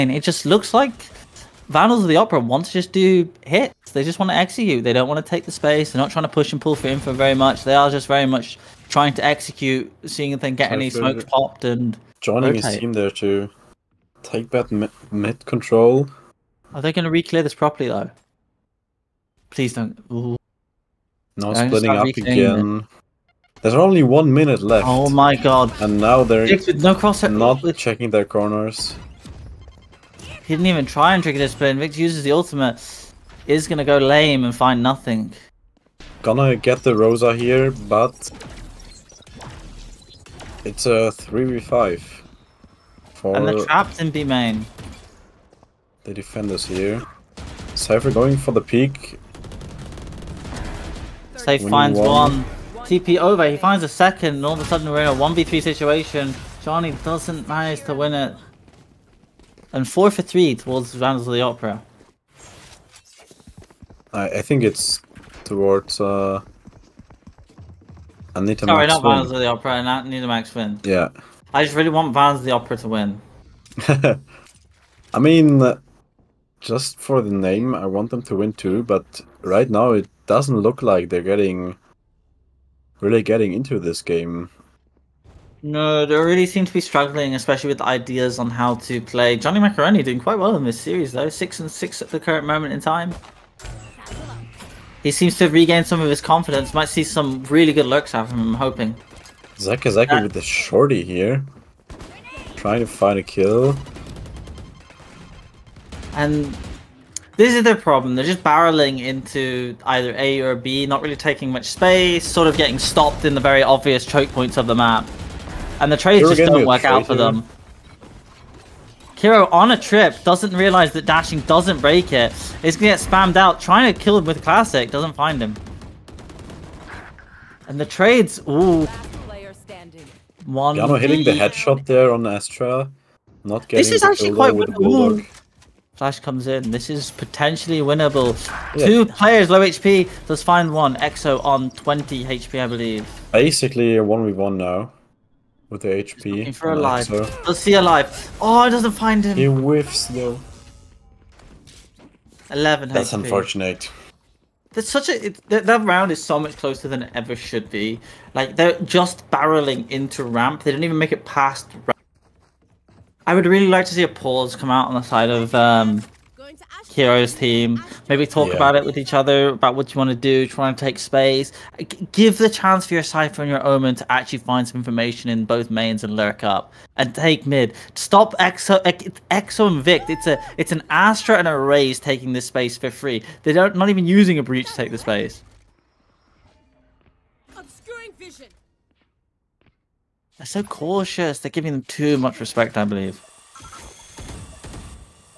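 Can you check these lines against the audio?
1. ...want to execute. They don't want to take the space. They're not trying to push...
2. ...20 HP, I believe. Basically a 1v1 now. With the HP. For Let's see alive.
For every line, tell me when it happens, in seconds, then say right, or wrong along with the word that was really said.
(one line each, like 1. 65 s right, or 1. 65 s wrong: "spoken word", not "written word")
1. 4 s right
2. 141 s right.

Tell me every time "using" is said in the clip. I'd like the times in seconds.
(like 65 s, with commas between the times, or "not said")
184 s.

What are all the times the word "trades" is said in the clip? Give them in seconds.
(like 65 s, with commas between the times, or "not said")
115 s, 127 s.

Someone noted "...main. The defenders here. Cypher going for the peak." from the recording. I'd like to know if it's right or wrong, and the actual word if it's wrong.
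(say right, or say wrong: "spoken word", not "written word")
right.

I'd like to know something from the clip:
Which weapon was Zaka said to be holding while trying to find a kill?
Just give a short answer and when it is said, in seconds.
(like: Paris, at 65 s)
Shorty, at 100 s.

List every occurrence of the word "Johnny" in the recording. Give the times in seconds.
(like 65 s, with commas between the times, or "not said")
56 s, 89 s.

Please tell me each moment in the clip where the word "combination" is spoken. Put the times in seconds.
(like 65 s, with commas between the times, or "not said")
not said.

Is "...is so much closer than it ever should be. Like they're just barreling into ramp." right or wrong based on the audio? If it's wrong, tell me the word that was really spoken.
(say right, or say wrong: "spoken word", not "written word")
right.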